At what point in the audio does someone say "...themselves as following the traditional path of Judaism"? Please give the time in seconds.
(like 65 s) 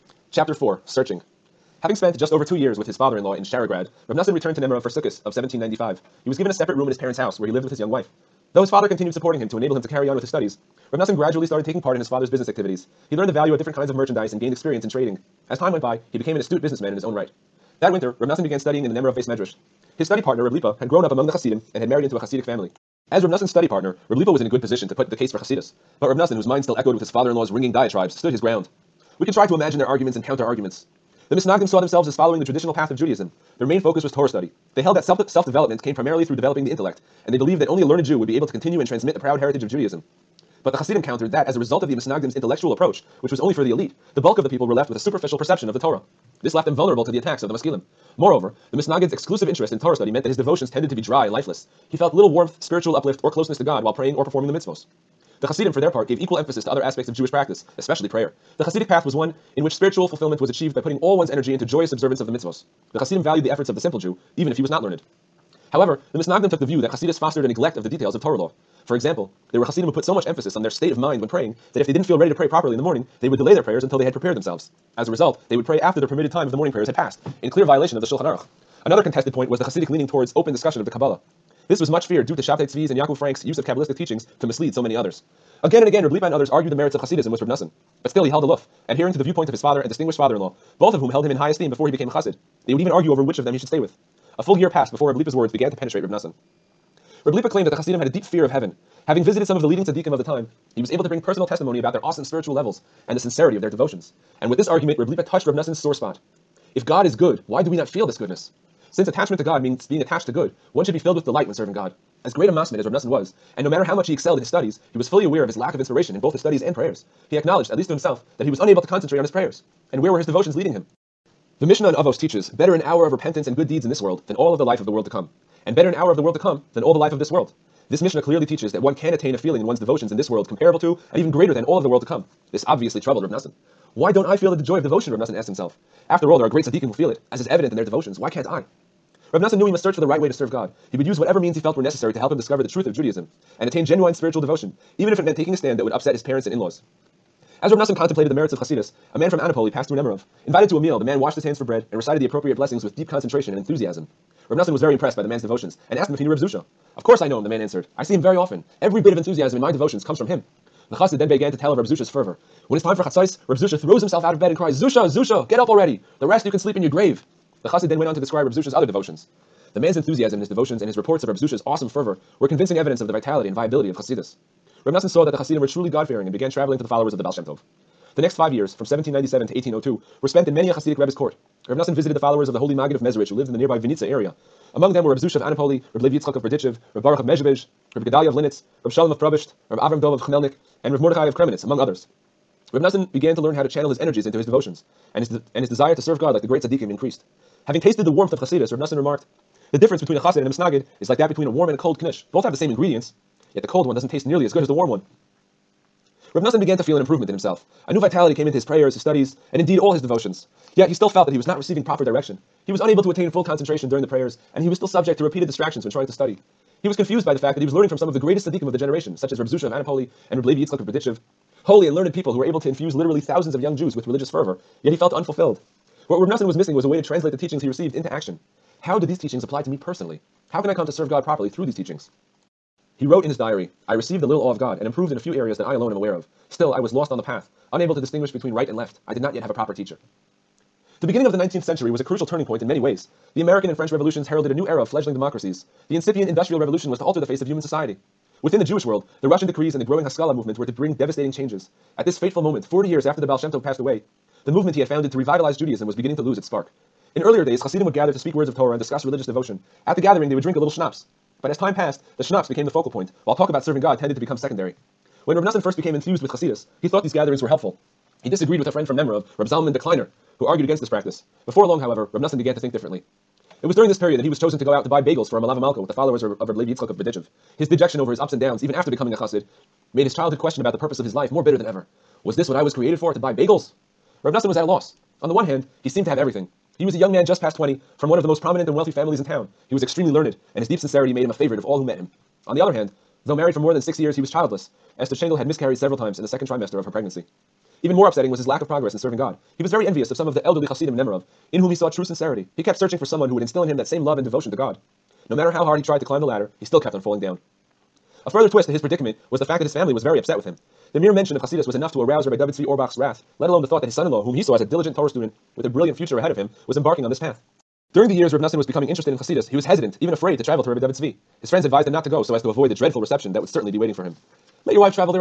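31 s.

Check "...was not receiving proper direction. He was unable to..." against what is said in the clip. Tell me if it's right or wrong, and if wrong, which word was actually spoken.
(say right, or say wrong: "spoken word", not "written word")
right.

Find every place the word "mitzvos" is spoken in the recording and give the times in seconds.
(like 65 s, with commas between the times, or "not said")
54 s, 62 s.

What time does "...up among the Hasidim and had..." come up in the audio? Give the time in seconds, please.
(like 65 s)
21 s.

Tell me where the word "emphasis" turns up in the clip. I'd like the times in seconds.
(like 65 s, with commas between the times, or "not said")
56 s, 70 s.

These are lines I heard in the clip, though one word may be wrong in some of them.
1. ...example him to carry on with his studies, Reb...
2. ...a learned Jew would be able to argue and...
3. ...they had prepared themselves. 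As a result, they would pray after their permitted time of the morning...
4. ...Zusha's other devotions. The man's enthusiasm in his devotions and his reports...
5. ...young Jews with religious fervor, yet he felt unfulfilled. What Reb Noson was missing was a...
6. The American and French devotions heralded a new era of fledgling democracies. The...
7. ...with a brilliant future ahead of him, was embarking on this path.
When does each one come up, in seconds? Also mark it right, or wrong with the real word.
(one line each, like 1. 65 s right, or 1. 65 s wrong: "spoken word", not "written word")
1. 9 s wrong: "enable", not "example"
2. 37 s wrong: "continue", not "argue"
3. 73 s right
4. 168 s right
5. 223 s right
6. 243 s wrong: "revolutions", not "devotions"
7. 315 s right.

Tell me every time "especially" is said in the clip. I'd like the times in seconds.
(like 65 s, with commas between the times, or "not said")
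57 s.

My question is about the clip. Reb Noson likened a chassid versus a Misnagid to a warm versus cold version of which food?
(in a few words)
Knish.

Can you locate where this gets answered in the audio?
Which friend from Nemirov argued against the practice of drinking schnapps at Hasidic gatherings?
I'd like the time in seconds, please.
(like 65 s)
269 s.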